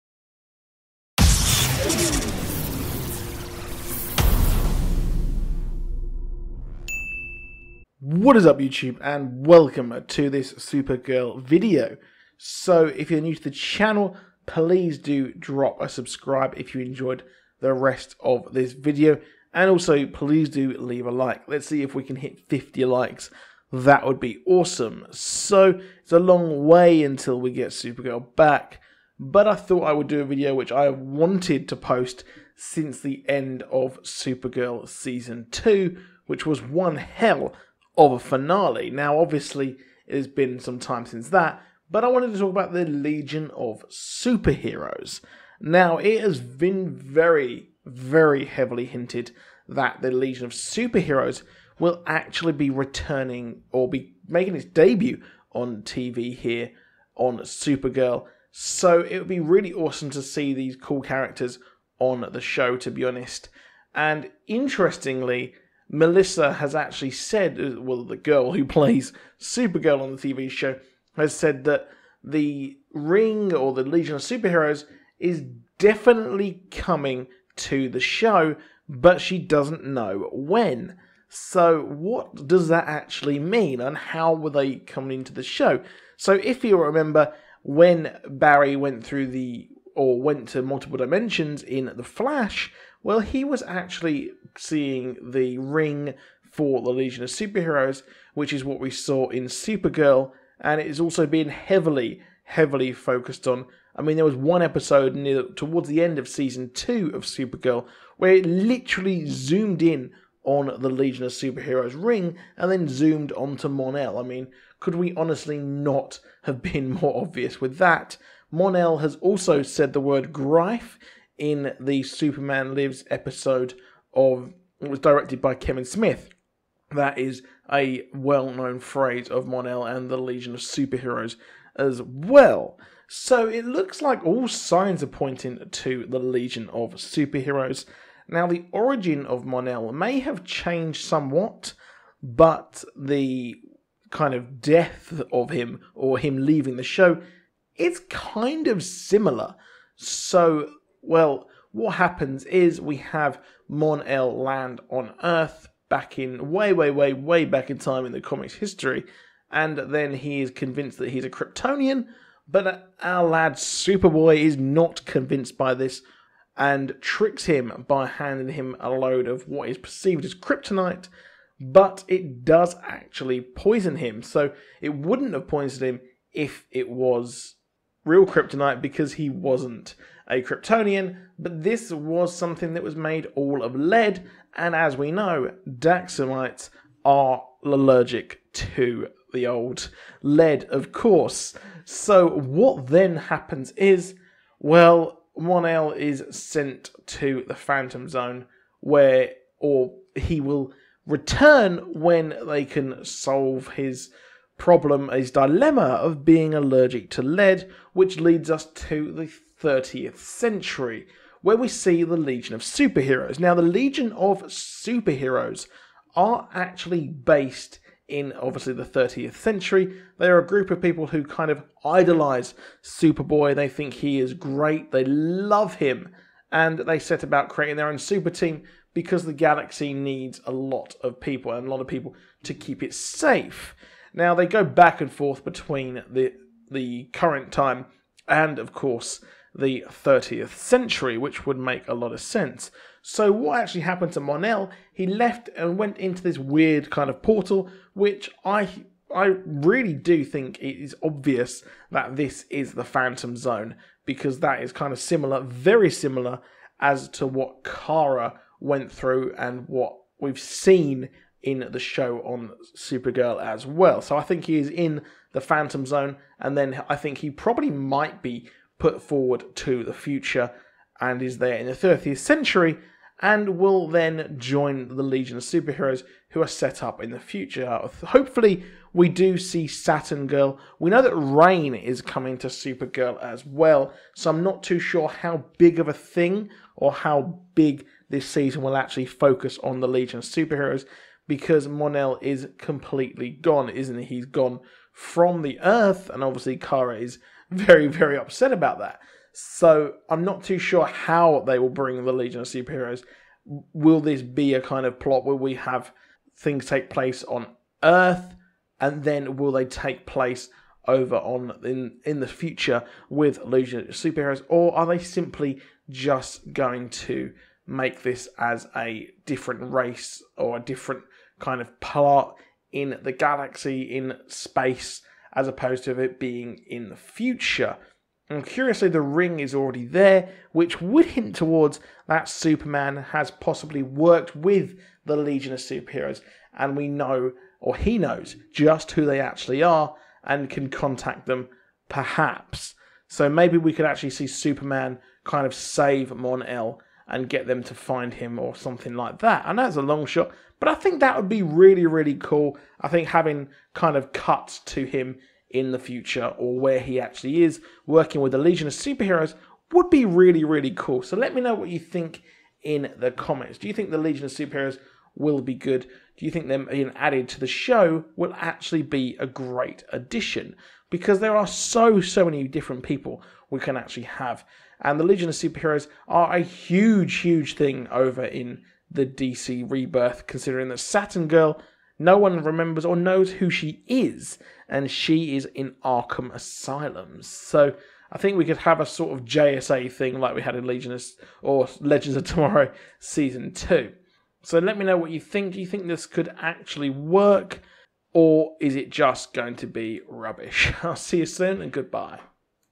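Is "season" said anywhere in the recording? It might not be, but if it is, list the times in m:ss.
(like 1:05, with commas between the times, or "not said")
0:34, 1:46, 4:48, 6:32.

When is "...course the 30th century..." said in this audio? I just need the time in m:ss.
3:58.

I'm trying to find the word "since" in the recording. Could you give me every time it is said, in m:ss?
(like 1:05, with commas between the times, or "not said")
0:32, 0:41.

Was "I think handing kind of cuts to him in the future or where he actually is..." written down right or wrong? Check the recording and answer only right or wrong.
wrong.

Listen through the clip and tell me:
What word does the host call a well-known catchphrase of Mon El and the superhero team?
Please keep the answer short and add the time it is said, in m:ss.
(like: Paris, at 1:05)
grife, at 2:00.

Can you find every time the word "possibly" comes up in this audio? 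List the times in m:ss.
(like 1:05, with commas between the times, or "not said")
5:33.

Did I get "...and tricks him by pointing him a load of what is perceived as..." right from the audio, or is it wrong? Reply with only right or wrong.
wrong.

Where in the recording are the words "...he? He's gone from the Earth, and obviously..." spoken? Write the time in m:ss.
4:53.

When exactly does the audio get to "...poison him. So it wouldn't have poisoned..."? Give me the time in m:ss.
2:53.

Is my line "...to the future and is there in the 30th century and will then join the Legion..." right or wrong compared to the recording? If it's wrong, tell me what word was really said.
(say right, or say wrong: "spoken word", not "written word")
right.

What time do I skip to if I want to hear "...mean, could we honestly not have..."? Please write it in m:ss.
1:54.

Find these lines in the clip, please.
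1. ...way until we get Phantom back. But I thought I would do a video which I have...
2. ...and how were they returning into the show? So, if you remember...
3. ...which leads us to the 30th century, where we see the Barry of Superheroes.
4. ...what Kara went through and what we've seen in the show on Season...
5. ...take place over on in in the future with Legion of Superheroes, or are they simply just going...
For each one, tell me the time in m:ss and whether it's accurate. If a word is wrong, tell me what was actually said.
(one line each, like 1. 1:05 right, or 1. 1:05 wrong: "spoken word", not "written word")
1. 0:26 wrong: "Supergirl", not "Phantom"
2. 1:23 wrong: "coming", not "returning"
3. 3:27 wrong: "Legion", not "Barry"
4. 4:17 wrong: "Supergirl", not "Season"
5. 5:09 right.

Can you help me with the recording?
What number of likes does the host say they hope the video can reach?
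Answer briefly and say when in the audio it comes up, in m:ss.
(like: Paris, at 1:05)
50, at 0:22.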